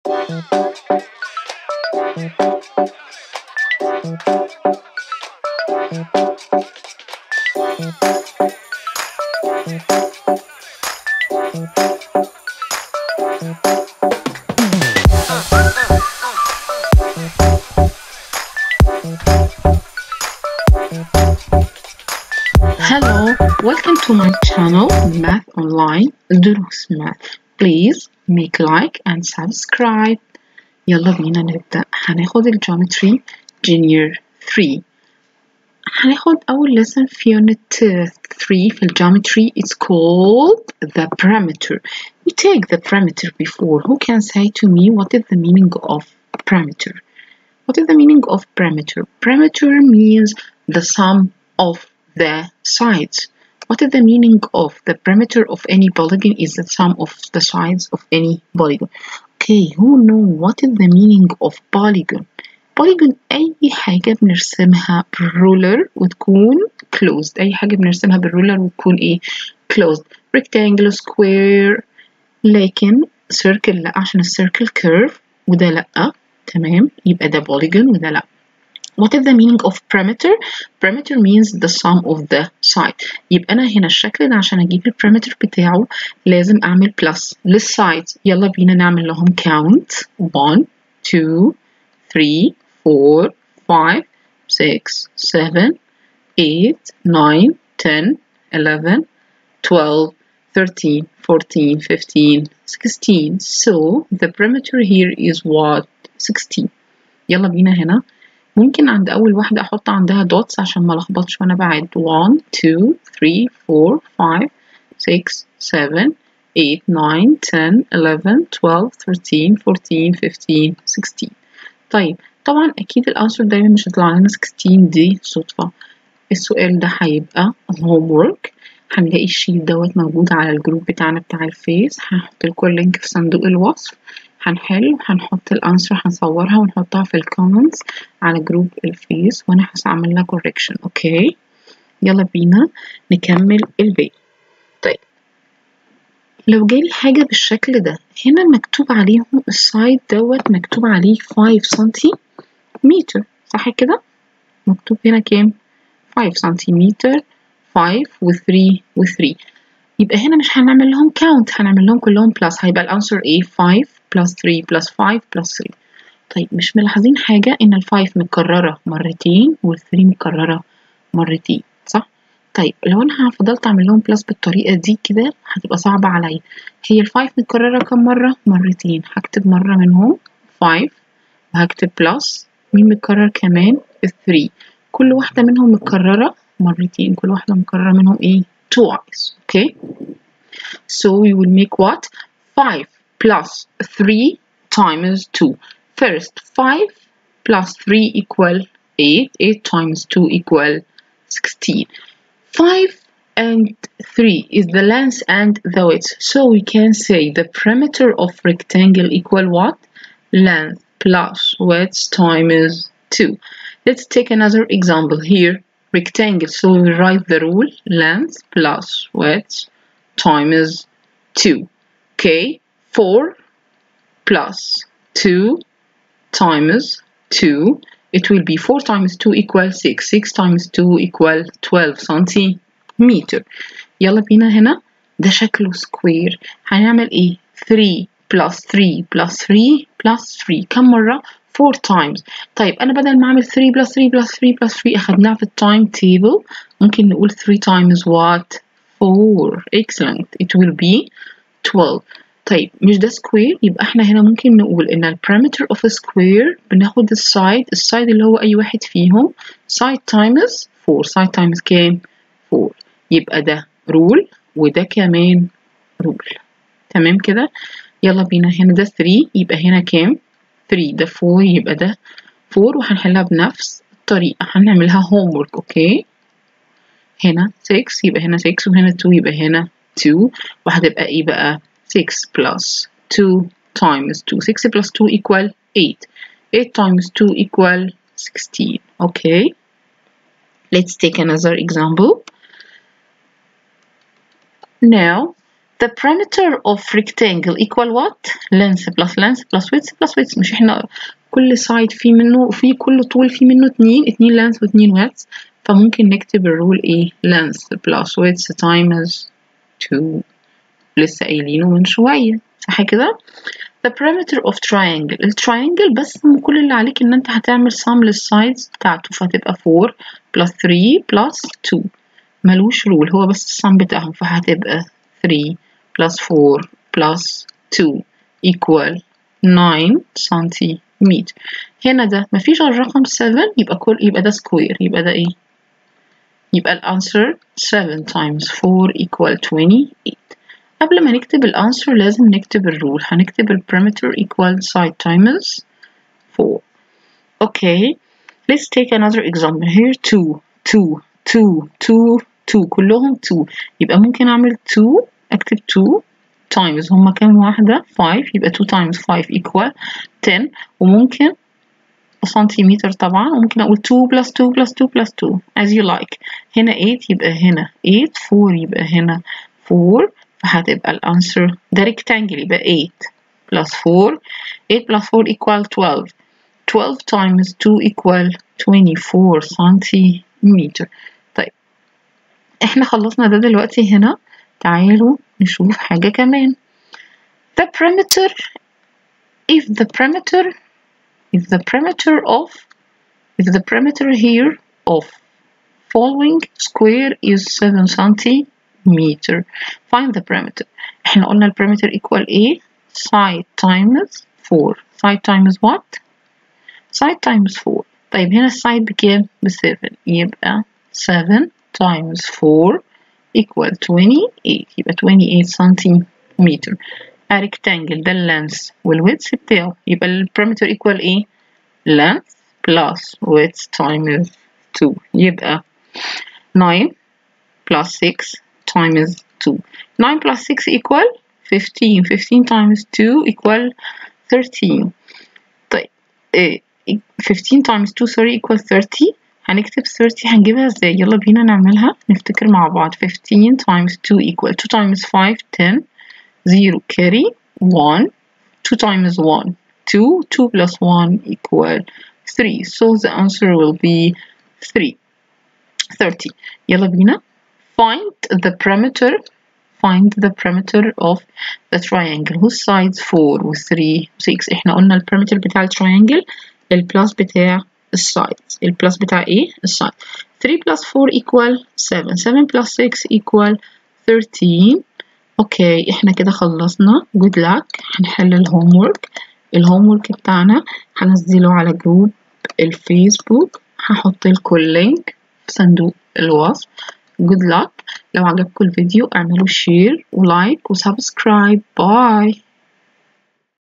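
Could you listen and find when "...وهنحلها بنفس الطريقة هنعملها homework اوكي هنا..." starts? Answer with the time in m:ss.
4:32.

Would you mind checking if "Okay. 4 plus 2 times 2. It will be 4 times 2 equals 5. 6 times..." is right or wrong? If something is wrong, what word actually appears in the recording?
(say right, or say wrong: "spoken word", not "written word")
wrong: "6", not "5".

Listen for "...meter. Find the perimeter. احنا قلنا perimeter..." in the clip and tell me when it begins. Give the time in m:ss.
6:38.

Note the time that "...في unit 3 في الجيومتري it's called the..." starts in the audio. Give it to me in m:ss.
0:37.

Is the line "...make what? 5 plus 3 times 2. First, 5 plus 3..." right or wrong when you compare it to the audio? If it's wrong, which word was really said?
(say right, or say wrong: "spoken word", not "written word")
right.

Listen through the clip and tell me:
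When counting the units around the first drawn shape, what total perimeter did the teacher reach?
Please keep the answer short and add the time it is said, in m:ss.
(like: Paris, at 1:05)
16, at 1:43.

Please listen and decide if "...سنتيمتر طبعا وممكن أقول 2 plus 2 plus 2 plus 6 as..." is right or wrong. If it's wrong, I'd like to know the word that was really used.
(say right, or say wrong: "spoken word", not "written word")
wrong: "2", not "6".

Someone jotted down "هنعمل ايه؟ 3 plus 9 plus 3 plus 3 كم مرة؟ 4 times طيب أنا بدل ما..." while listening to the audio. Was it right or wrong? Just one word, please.
wrong.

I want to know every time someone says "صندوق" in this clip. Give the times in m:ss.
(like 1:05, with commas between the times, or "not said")
2:13, 8:05.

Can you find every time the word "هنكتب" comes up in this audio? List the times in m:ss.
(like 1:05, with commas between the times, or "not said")
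5:43, 7:19.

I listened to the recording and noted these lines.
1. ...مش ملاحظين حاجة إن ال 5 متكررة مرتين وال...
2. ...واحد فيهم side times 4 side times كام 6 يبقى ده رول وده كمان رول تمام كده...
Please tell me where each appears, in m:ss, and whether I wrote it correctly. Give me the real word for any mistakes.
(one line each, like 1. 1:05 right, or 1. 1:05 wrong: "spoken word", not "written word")
1. 2:46 right
2. 4:18 wrong: "4", not "6".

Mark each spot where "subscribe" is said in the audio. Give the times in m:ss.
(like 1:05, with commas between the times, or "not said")
0:29.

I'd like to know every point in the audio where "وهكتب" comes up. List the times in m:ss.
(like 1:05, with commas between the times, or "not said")
3:01.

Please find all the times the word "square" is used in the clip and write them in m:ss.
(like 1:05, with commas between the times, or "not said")
1:11, 4:15, 6:36.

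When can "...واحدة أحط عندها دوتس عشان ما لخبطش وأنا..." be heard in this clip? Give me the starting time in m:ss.
1:49.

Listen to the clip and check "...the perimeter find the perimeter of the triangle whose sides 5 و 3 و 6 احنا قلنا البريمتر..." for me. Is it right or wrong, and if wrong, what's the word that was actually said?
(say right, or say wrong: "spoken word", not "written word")
wrong: "4", not "5".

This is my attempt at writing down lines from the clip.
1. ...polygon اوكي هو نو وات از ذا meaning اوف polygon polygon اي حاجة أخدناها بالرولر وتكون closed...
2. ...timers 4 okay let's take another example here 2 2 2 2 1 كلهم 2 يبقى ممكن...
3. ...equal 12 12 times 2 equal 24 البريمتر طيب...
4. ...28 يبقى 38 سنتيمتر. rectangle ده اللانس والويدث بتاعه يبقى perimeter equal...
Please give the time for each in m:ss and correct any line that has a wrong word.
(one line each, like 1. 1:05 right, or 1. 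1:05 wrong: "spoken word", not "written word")
1. 0:58 wrong: "بنرسمها", not "أخدناها"
2. 5:45 wrong: "2", not "1"
3. 6:15 wrong: "سنتيمتر", not "البريمتر"
4. 6:53 wrong: "28", not "38".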